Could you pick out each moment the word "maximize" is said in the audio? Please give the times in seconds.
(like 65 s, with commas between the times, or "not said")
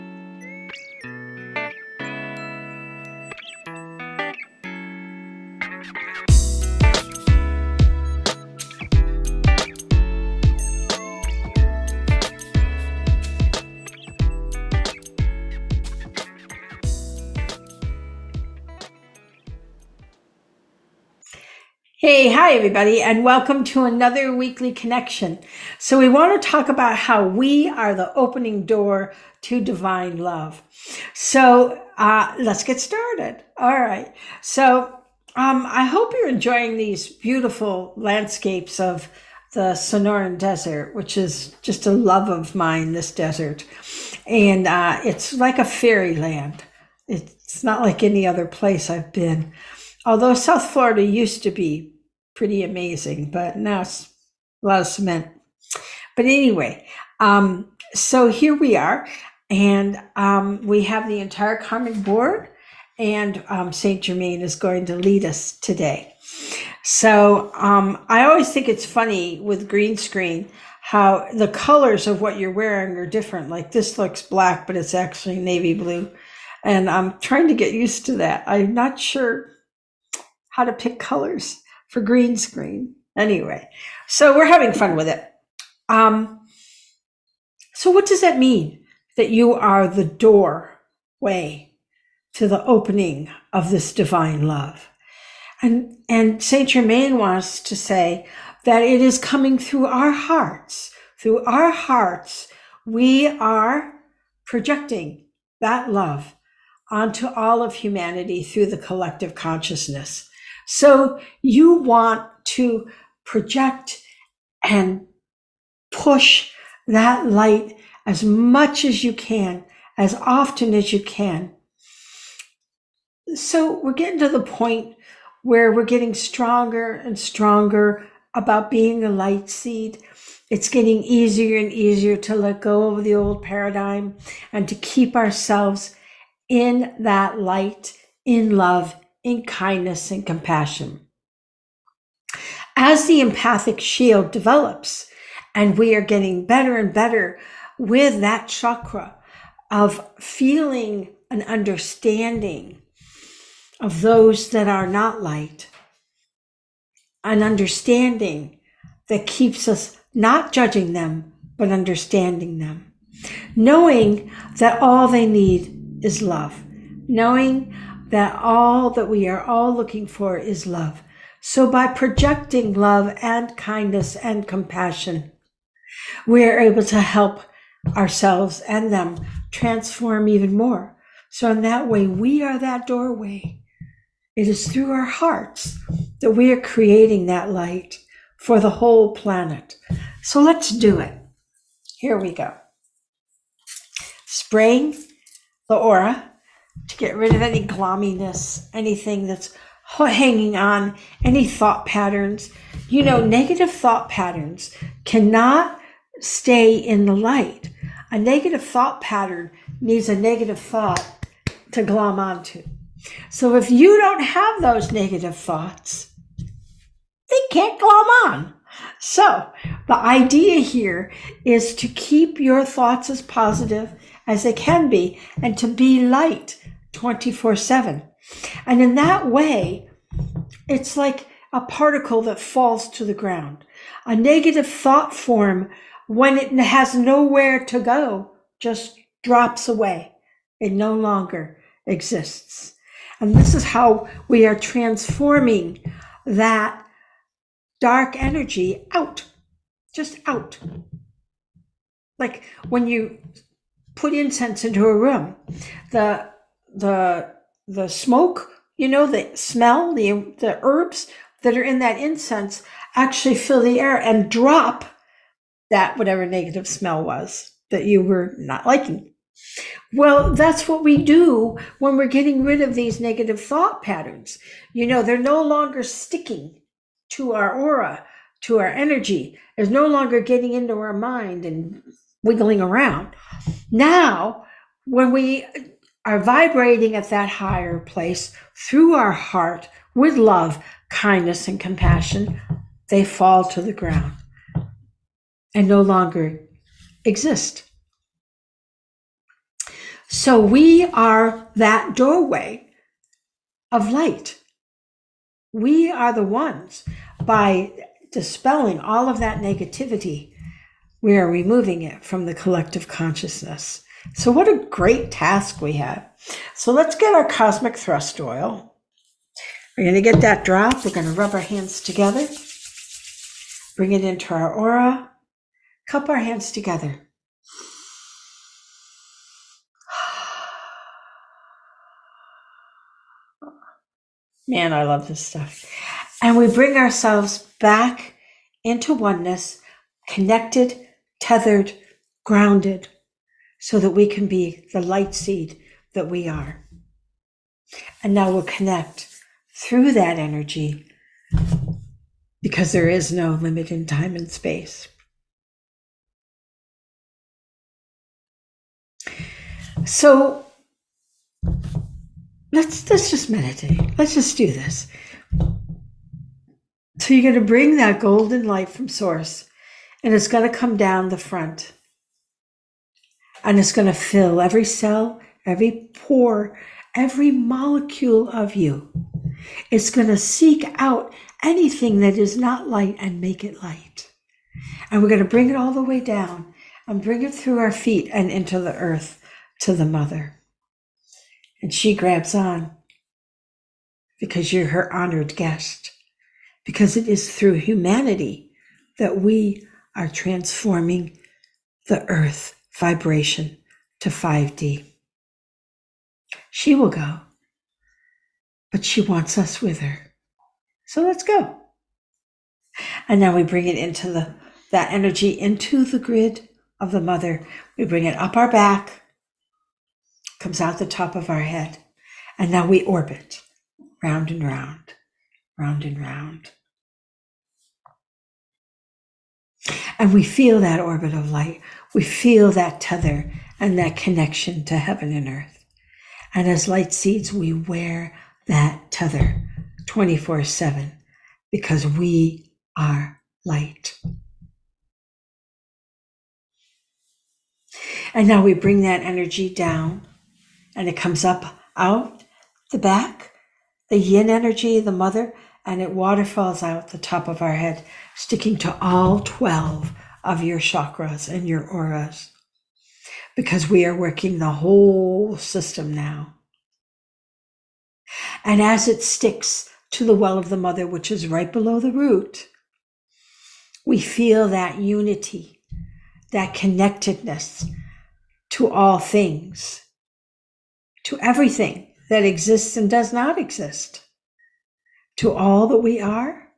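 not said.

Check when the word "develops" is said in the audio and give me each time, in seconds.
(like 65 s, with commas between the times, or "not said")
144 s.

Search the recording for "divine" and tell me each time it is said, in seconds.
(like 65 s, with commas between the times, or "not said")
29 s, 93 s.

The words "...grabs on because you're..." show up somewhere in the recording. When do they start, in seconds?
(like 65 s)
391 s.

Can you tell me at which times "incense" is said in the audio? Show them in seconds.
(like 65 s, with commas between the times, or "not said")
254 s, 261 s.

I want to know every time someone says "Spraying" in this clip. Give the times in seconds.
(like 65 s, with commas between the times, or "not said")
194 s.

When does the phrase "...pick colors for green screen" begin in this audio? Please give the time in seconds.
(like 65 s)
80 s.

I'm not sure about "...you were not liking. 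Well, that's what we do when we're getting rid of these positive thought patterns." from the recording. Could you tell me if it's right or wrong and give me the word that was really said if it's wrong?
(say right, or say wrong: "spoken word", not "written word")
wrong: "negative", not "positive".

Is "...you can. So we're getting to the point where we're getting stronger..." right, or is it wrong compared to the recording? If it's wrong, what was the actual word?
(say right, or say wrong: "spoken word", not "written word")
right.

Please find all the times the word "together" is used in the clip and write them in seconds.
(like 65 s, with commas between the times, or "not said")
321 s, 326 s.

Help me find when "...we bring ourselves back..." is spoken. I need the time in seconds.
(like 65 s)
336 s.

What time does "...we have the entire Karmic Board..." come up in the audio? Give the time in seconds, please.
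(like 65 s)
60 s.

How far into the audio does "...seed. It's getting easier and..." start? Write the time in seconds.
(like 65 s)
129 s.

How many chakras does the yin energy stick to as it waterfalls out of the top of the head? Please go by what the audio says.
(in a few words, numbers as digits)
12.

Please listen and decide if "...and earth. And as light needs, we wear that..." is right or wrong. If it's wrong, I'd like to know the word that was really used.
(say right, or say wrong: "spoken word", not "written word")
wrong: "seeds", not "needs".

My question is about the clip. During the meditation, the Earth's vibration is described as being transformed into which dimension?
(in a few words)
5D.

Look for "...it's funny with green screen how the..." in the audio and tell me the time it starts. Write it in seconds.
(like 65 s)
68 s.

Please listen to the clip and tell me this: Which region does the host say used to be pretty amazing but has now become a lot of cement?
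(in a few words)
South Florida.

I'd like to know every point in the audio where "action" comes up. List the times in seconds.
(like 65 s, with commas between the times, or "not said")
not said.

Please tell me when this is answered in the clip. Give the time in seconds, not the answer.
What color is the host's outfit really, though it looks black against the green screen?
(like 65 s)
75 s.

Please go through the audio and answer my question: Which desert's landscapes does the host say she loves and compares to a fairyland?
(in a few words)
Sonoran Desert.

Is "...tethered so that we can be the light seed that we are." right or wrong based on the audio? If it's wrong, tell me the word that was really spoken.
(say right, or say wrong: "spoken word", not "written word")
wrong: "grounded", not "tethered".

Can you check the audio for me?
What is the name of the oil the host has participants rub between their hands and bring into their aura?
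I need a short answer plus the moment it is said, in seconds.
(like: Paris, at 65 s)
cosmic thrust oil, at 317 s.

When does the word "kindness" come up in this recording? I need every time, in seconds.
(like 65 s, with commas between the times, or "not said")
139 s, 173 s, 290 s.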